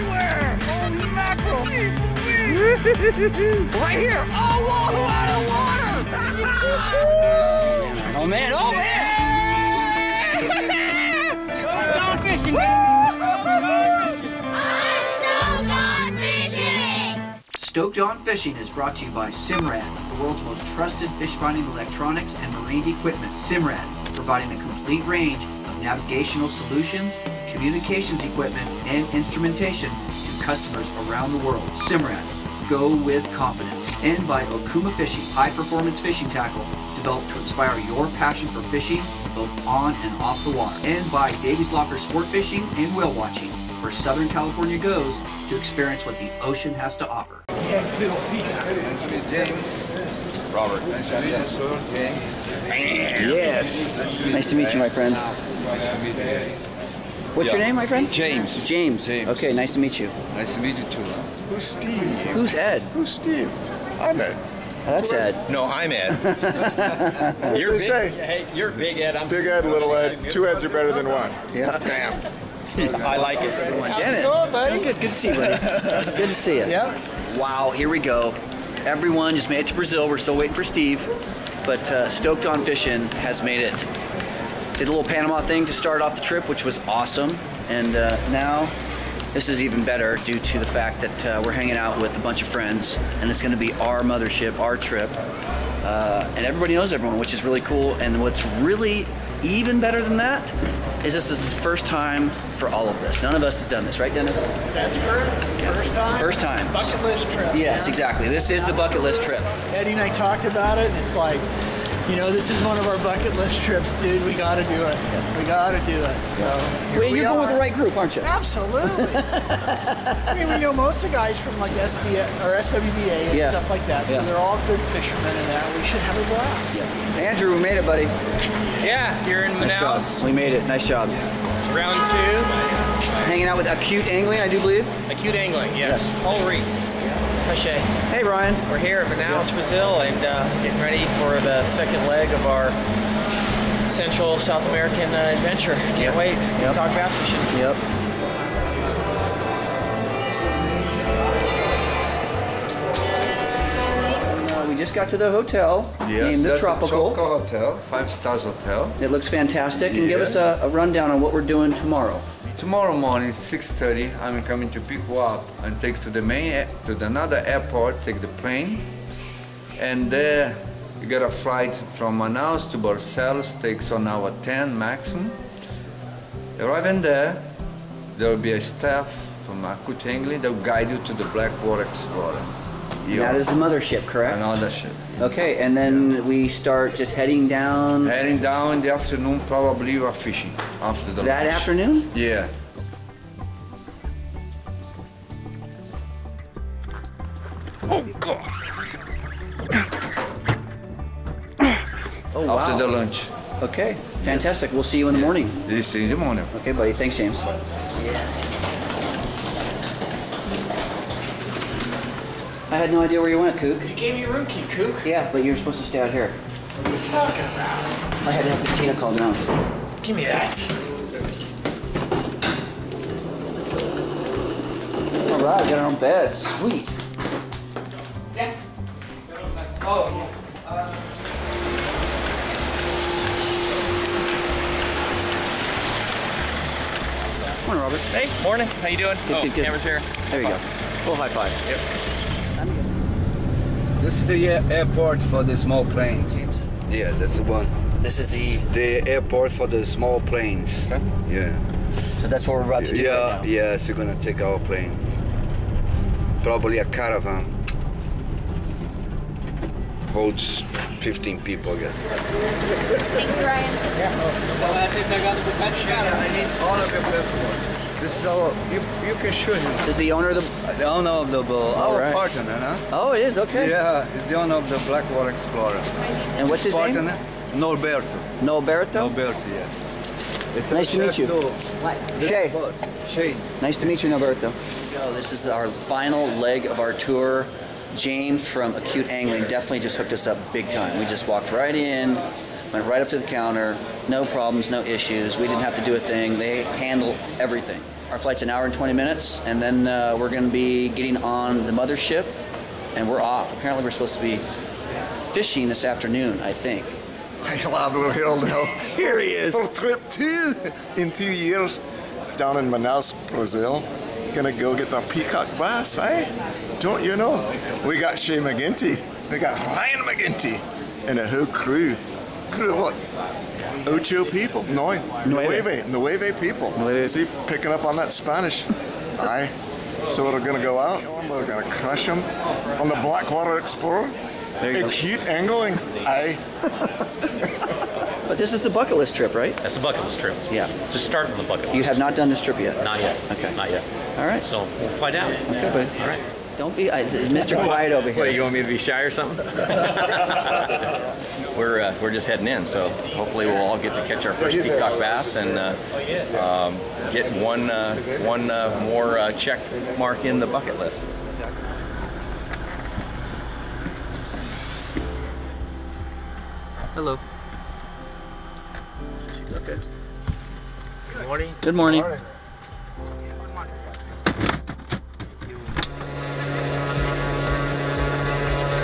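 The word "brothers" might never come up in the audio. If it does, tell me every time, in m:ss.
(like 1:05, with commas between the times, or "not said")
not said.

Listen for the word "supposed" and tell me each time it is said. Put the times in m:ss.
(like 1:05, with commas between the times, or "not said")
3:35, 5:03.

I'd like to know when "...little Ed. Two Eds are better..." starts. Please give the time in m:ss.
1:09.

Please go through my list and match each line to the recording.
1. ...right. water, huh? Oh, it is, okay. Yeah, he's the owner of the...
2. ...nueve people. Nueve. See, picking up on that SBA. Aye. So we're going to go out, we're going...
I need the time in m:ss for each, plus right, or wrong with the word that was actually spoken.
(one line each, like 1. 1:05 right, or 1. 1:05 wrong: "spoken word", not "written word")
1. 4:32 wrong: "partner", not "water"
2. 5:25 wrong: "Spanish", not "SBA".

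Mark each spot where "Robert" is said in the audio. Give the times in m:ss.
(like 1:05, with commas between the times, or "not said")
0:50, 3:57.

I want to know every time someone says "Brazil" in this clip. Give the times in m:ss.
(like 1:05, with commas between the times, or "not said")
1:19, 2:19, 5:13.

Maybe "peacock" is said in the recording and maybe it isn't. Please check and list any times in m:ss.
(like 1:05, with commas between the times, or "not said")
5:15, 5:54.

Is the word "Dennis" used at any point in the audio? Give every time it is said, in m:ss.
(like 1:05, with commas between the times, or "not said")
1:13, 1:44.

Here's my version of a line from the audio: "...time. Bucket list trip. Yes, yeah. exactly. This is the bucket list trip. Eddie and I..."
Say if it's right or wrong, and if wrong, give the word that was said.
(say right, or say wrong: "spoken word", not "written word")
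right.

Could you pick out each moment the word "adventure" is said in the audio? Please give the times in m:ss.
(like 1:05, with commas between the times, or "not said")
2:25.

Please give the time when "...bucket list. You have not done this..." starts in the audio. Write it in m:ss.
5:41.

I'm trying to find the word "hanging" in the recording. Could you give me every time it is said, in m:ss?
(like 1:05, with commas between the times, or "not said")
1:31, 2:13.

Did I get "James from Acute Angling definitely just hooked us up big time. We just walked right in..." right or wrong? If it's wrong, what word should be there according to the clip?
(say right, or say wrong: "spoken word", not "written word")
right.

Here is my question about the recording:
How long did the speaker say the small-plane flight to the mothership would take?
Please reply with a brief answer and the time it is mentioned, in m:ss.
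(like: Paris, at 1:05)
1 hour 20 minutes, at 4:58.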